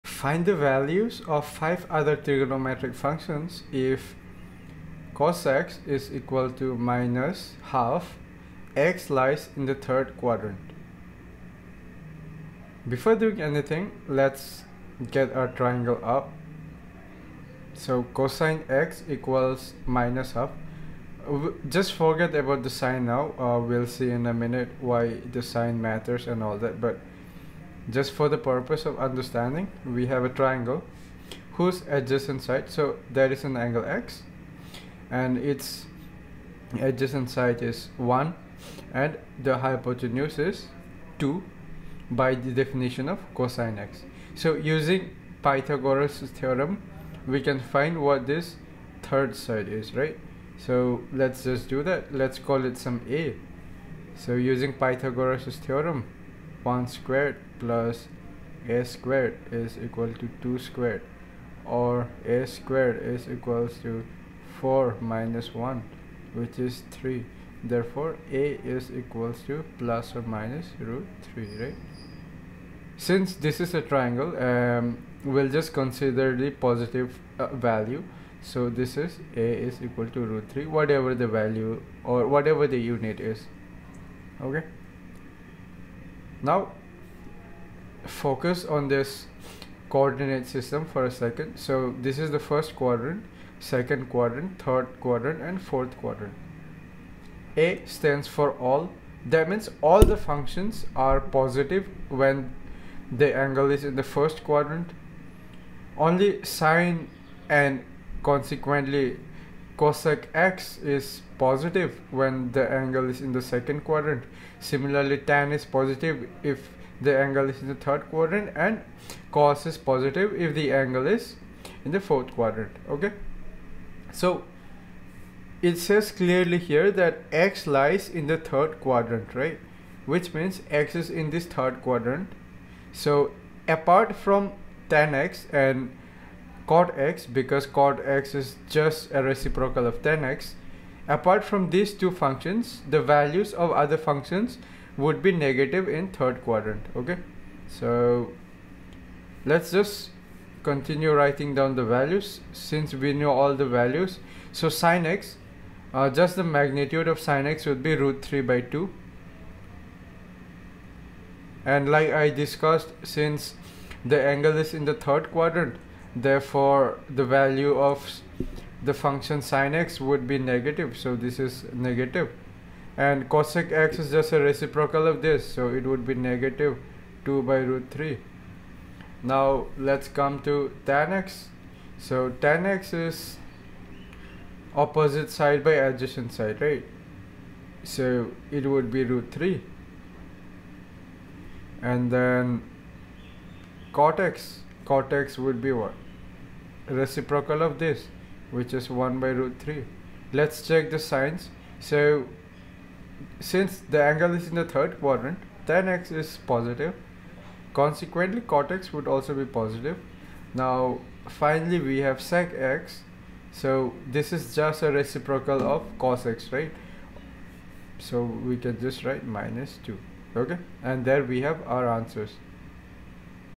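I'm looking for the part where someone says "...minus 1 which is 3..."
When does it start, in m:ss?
1:05.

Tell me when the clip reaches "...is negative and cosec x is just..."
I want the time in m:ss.
2:51.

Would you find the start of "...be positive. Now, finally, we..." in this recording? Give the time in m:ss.
3:29.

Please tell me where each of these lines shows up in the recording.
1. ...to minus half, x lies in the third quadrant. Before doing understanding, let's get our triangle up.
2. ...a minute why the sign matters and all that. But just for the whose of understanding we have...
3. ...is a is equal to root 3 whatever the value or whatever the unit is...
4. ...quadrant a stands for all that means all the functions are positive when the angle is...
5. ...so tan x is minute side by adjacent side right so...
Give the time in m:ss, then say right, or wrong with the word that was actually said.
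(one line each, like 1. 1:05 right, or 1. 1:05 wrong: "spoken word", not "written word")
1. 0:06 wrong: "anything", not "understanding"
2. 0:24 wrong: "purpose", not "whose"
3. 1:18 right
4. 1:35 right
5. 3:01 wrong: "opposite", not "minute".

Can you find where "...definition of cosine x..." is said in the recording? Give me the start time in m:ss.
0:42.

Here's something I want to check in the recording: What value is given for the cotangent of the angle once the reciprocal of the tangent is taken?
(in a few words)
1 by root 3.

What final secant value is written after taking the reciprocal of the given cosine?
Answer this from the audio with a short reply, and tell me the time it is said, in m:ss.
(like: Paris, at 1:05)
-2, at 3:39.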